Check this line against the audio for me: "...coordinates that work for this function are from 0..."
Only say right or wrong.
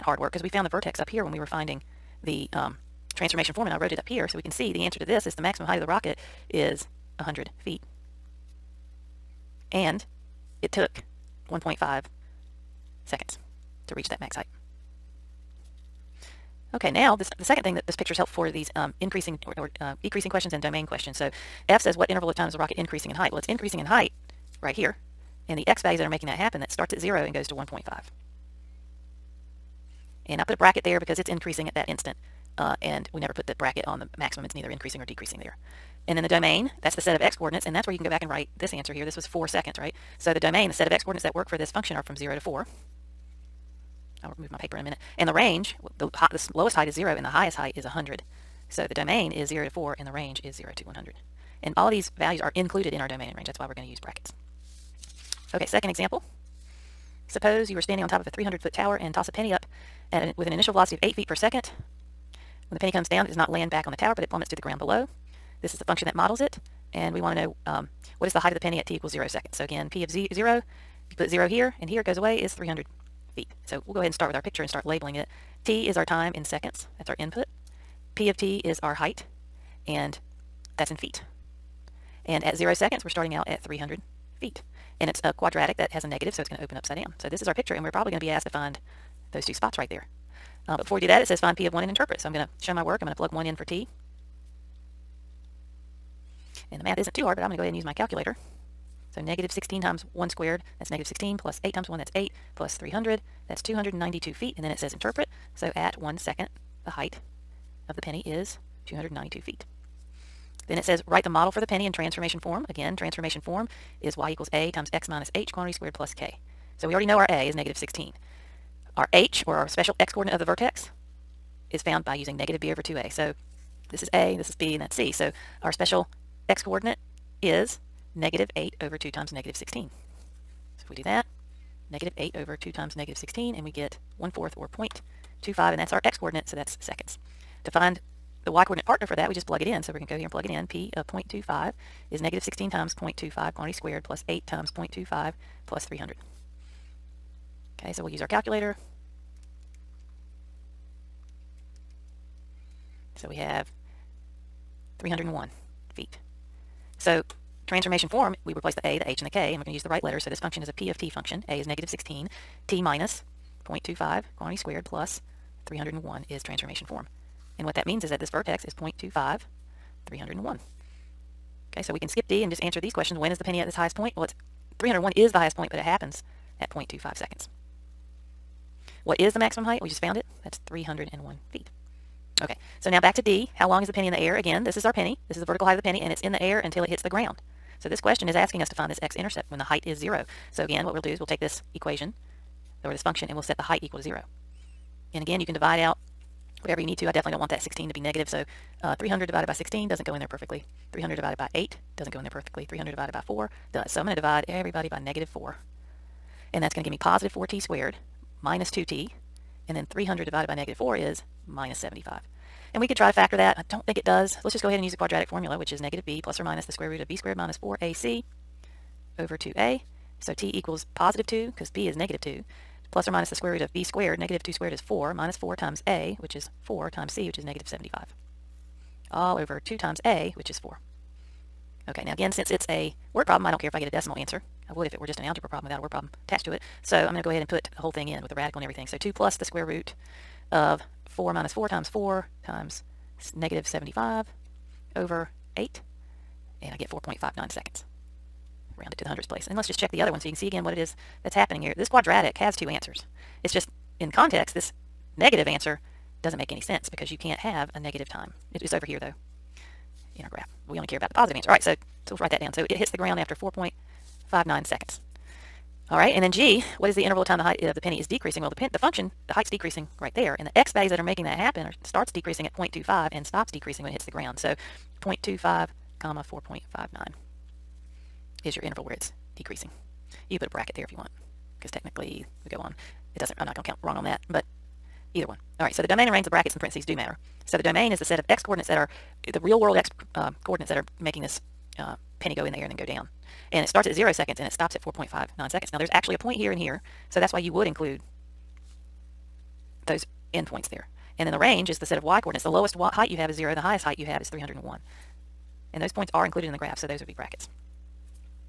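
right.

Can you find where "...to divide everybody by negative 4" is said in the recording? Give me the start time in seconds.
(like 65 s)
204 s.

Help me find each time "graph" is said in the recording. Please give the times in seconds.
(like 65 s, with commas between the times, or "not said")
260 s, 306 s.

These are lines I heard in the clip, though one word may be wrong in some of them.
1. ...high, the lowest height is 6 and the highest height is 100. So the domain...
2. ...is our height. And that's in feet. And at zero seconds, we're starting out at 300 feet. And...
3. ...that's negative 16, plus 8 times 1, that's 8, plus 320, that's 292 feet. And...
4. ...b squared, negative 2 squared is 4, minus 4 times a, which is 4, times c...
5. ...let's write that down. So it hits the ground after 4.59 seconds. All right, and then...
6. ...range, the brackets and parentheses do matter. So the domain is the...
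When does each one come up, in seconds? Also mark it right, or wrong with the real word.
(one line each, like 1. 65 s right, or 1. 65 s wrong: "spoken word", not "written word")
1. 46 s wrong: "0", not "6"
2. 78 s right
3. 100 s wrong: "300", not "320"
4. 223 s right
5. 262 s right
6. 286 s right.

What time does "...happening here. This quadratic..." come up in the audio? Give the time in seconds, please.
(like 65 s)
251 s.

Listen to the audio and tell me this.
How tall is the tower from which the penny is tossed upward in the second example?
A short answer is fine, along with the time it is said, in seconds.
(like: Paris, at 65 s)
300 foot, at 58 s.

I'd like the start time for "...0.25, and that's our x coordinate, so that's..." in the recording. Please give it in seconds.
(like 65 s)
134 s.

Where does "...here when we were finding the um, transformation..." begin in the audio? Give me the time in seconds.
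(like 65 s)
1 s.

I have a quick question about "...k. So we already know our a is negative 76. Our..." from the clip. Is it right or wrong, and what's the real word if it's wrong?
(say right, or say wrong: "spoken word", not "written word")
wrong: "16", not "76".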